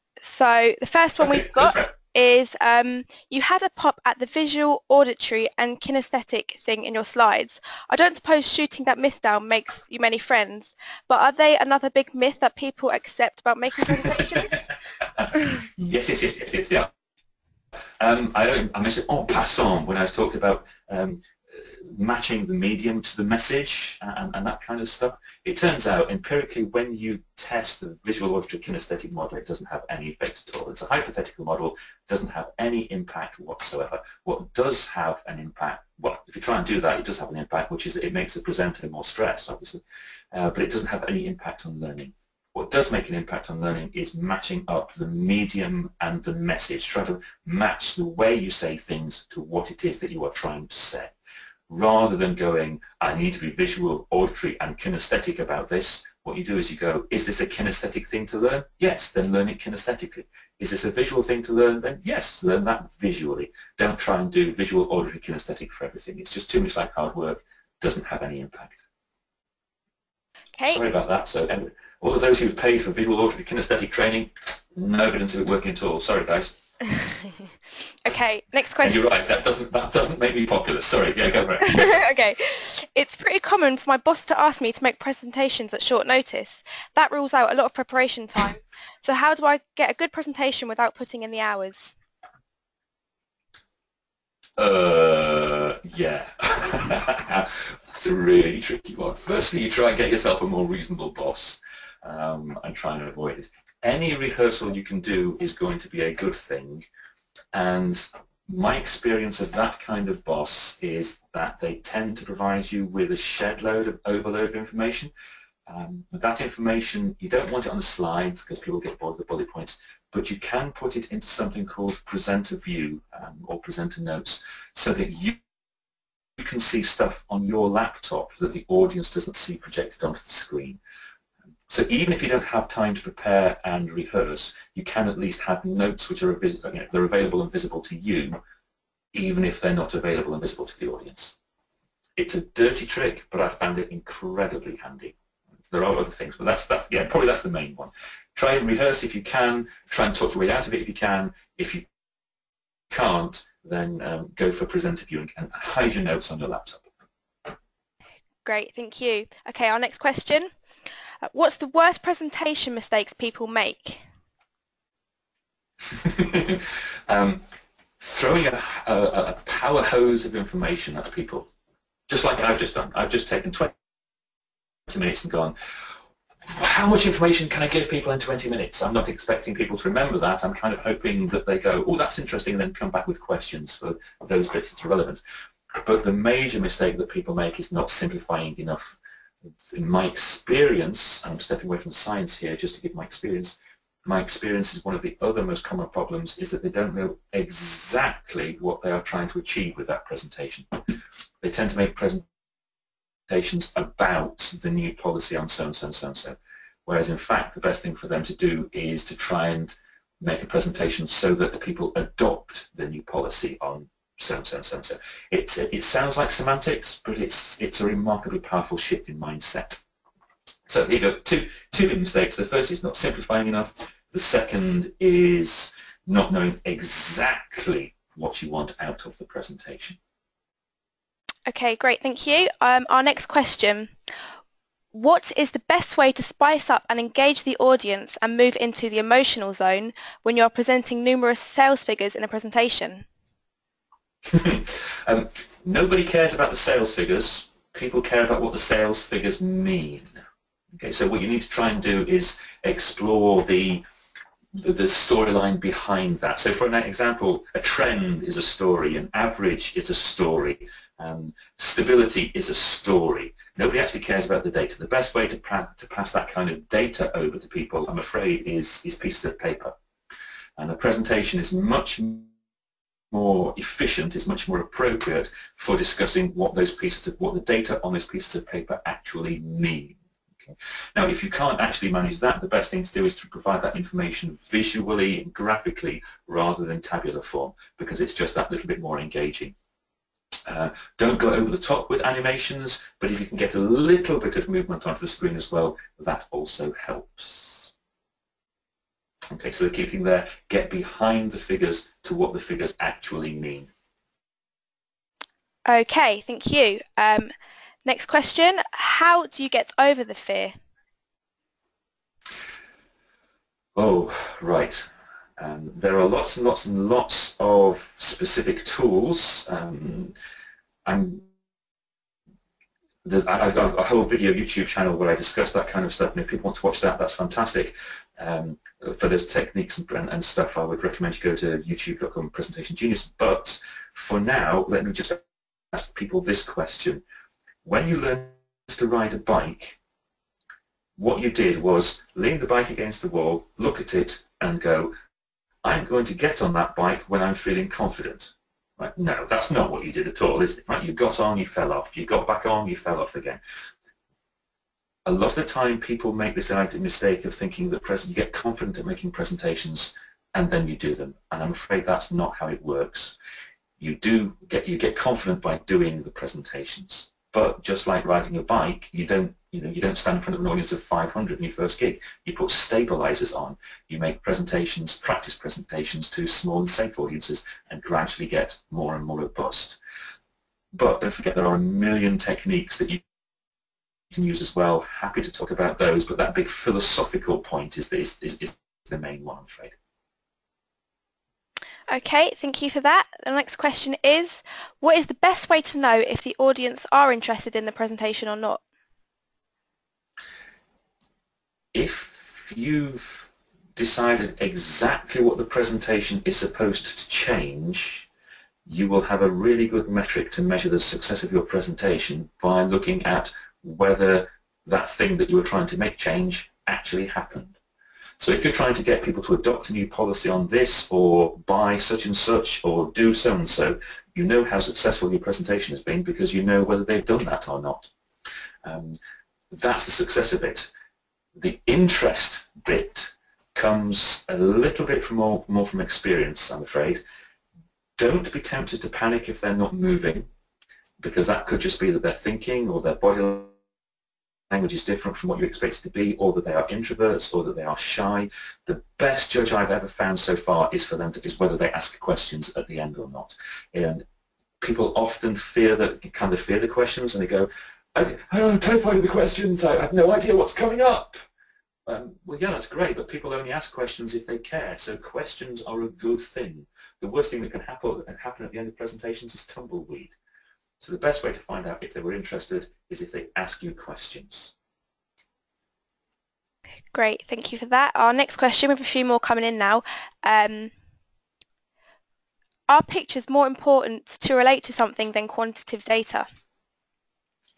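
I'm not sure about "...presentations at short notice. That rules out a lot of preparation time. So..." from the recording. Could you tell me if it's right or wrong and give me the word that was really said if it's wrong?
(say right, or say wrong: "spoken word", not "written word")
right.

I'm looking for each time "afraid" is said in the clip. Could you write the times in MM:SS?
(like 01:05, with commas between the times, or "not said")
04:27, 06:01, 06:29, 07:16.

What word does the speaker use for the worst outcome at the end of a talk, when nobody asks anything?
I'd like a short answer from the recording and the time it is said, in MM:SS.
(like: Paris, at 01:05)
Tumbleweed, at 07:49.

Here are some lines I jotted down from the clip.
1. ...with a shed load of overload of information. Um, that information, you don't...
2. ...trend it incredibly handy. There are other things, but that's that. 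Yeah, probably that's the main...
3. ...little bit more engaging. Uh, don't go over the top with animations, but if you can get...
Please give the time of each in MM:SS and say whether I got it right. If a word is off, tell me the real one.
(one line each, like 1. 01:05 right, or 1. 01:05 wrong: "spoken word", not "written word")
1. 01:52 right
2. 02:23 wrong: "found", not "trend"
3. 04:48 right.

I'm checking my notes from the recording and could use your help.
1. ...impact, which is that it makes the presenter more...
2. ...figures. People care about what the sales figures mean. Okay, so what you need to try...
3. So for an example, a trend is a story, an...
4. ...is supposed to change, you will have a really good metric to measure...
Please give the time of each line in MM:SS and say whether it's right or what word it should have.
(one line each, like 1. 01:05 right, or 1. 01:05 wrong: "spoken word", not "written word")
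1. 00:37 right
2. 04:06 right
3. 04:16 right
4. 06:46 right.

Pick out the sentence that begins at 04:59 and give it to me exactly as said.
Okay, so the key thing there, get behind the figures to what the figures actually mean.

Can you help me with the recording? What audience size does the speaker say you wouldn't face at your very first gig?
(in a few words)
500.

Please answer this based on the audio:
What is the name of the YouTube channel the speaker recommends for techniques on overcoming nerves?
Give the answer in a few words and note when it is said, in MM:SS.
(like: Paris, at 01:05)
Presentation Genius, at 05:32.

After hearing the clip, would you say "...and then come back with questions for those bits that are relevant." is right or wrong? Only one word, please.
right.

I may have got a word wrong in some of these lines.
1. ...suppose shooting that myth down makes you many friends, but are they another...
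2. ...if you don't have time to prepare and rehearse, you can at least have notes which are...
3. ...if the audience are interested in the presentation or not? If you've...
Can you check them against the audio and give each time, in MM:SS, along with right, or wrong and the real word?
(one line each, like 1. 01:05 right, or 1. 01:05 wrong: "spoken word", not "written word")
1. 00:08 right
2. 02:12 right
3. 06:36 right.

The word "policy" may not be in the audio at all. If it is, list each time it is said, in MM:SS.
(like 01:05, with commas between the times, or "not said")
03:24, 03:33, 06:59.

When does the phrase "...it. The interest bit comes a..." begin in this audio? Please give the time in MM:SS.
07:10.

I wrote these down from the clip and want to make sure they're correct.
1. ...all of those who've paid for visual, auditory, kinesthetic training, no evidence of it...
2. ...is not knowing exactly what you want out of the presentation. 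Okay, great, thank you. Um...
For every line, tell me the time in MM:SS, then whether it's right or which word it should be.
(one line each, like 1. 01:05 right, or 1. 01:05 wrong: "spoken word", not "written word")
1. 01:12 right
2. 03:44 right.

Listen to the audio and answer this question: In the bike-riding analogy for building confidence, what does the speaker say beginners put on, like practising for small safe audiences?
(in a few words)
Stabilizers.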